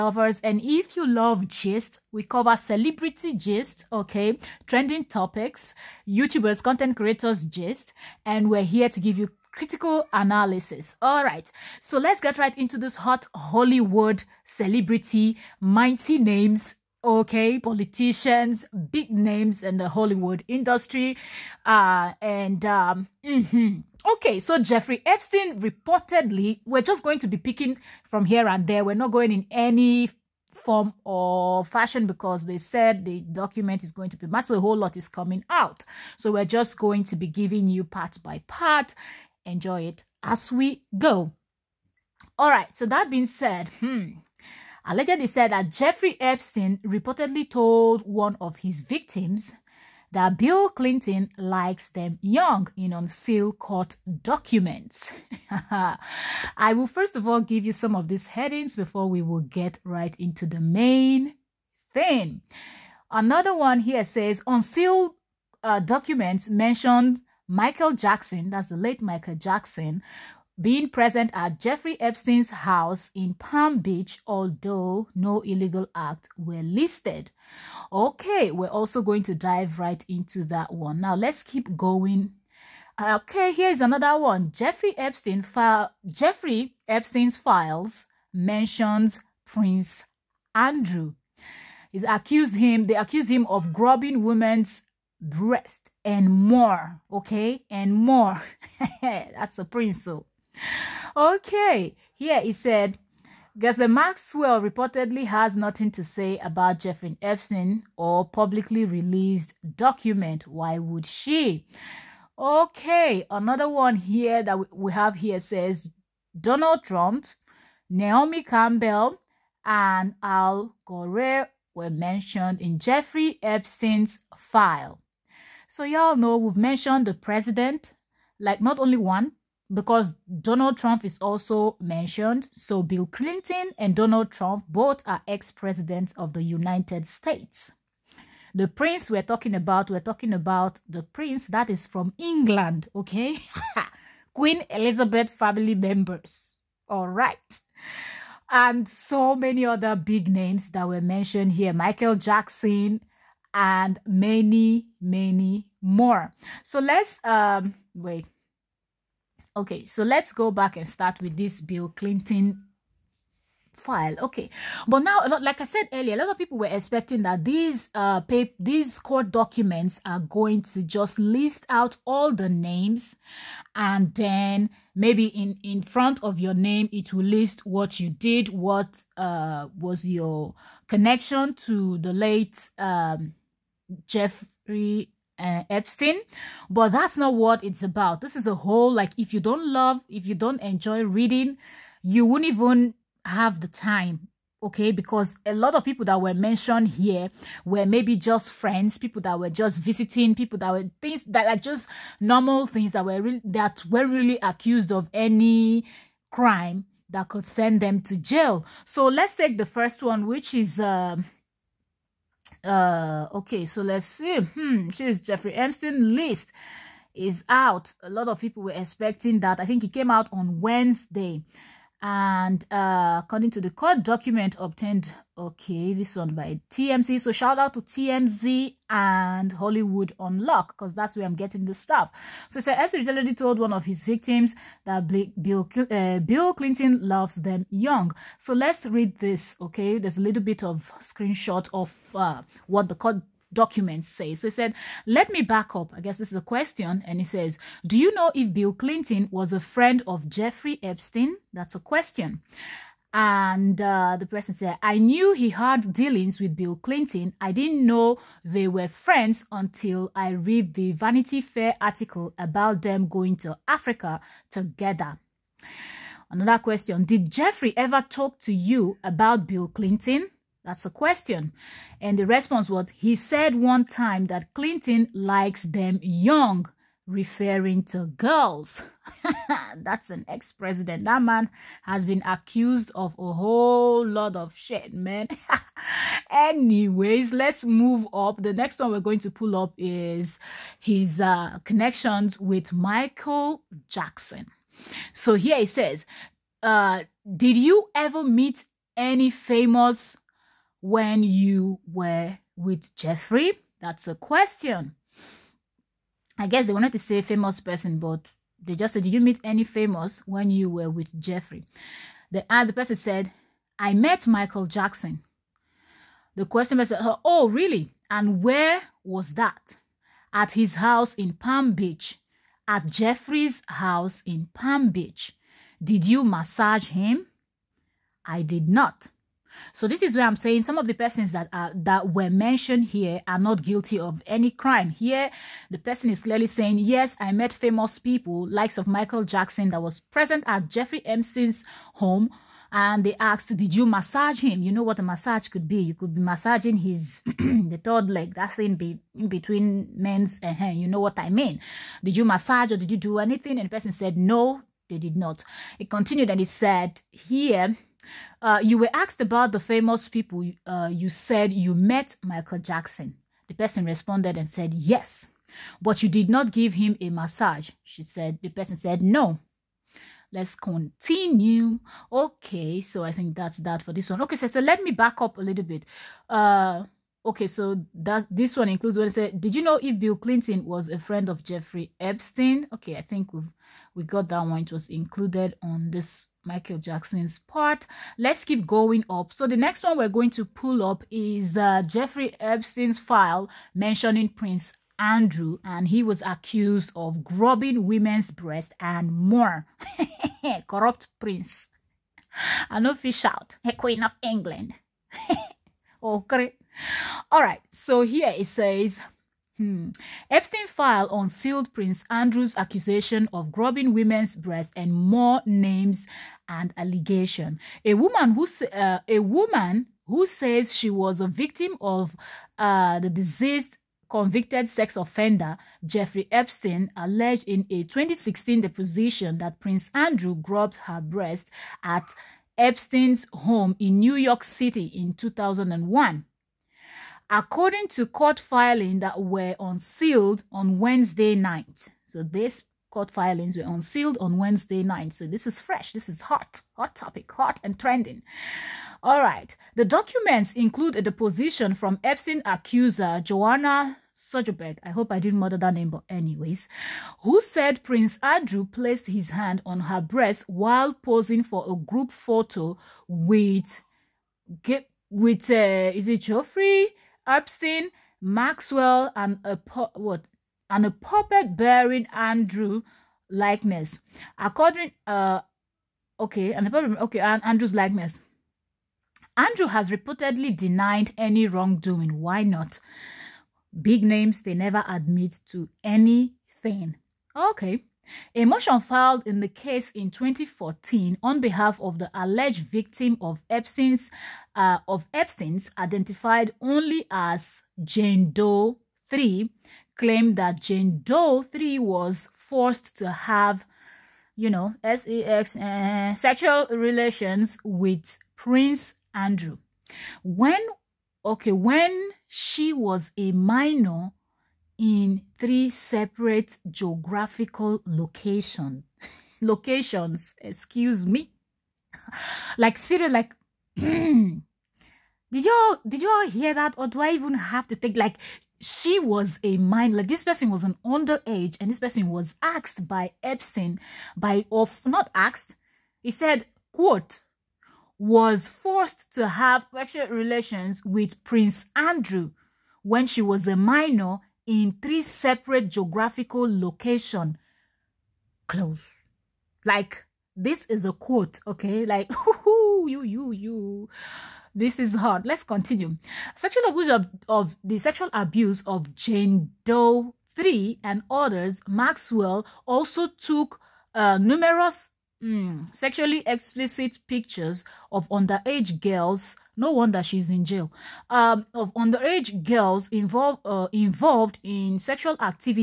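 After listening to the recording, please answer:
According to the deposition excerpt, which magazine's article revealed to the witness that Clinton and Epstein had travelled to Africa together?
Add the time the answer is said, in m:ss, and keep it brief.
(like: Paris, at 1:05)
Vanity Fair, at 4:20.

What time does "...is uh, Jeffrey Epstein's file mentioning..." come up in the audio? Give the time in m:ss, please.
6:31.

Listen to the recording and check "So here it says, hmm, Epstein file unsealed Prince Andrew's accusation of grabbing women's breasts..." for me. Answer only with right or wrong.
right.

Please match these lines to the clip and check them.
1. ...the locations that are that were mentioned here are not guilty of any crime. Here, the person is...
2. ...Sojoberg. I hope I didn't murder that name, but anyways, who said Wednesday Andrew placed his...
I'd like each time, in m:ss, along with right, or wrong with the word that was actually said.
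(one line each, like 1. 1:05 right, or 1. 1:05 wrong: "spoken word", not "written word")
1. 5:30 wrong: "persons", not "locations"
2. 7:34 wrong: "Prince", not "Wednesday".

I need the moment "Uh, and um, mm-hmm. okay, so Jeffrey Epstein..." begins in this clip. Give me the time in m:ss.
0:21.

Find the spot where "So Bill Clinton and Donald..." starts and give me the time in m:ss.
2:12.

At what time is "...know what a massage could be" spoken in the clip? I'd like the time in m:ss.
5:44.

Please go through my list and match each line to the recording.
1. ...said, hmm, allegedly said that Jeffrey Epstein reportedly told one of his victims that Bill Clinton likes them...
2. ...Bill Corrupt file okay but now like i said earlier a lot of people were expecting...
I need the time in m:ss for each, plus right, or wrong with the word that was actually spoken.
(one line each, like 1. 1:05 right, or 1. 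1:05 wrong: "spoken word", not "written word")
1. 0:43 right
2. 2:41 wrong: "Clinton", not "Corrupt".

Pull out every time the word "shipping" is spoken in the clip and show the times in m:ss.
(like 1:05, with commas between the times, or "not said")
not said.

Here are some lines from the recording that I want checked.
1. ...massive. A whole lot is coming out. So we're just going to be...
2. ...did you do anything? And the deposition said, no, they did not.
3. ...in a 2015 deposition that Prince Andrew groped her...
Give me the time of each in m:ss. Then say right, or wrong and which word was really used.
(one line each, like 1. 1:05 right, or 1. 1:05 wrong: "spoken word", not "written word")
1. 0:34 right
2. 5:52 wrong: "person", not "deposition"
3. 7:07 wrong: "2016", not "2015".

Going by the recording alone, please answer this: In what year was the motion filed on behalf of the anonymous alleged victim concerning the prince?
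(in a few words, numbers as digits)
2014.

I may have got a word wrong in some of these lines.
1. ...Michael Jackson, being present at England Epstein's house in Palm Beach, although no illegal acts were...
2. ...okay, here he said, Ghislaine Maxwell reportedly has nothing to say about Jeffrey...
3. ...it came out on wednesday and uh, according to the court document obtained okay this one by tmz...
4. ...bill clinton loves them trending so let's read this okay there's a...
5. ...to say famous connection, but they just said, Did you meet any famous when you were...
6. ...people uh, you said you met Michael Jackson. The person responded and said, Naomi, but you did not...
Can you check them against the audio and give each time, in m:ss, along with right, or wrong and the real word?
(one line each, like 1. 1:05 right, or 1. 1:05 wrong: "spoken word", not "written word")
1. 1:09 wrong: "Jeffrey", not "England"
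2. 1:41 right
3. 3:39 right
4. 3:56 wrong: "young", not "trending"
5. 5:06 wrong: "person", not "connection"
6. 6:00 wrong: "Yes", not "Naomi".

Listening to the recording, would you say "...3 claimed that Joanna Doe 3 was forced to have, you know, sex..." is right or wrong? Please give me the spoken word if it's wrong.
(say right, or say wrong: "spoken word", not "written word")
wrong: "Jane", not "Joanna".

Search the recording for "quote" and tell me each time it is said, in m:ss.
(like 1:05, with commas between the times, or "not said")
8:56, 9:10.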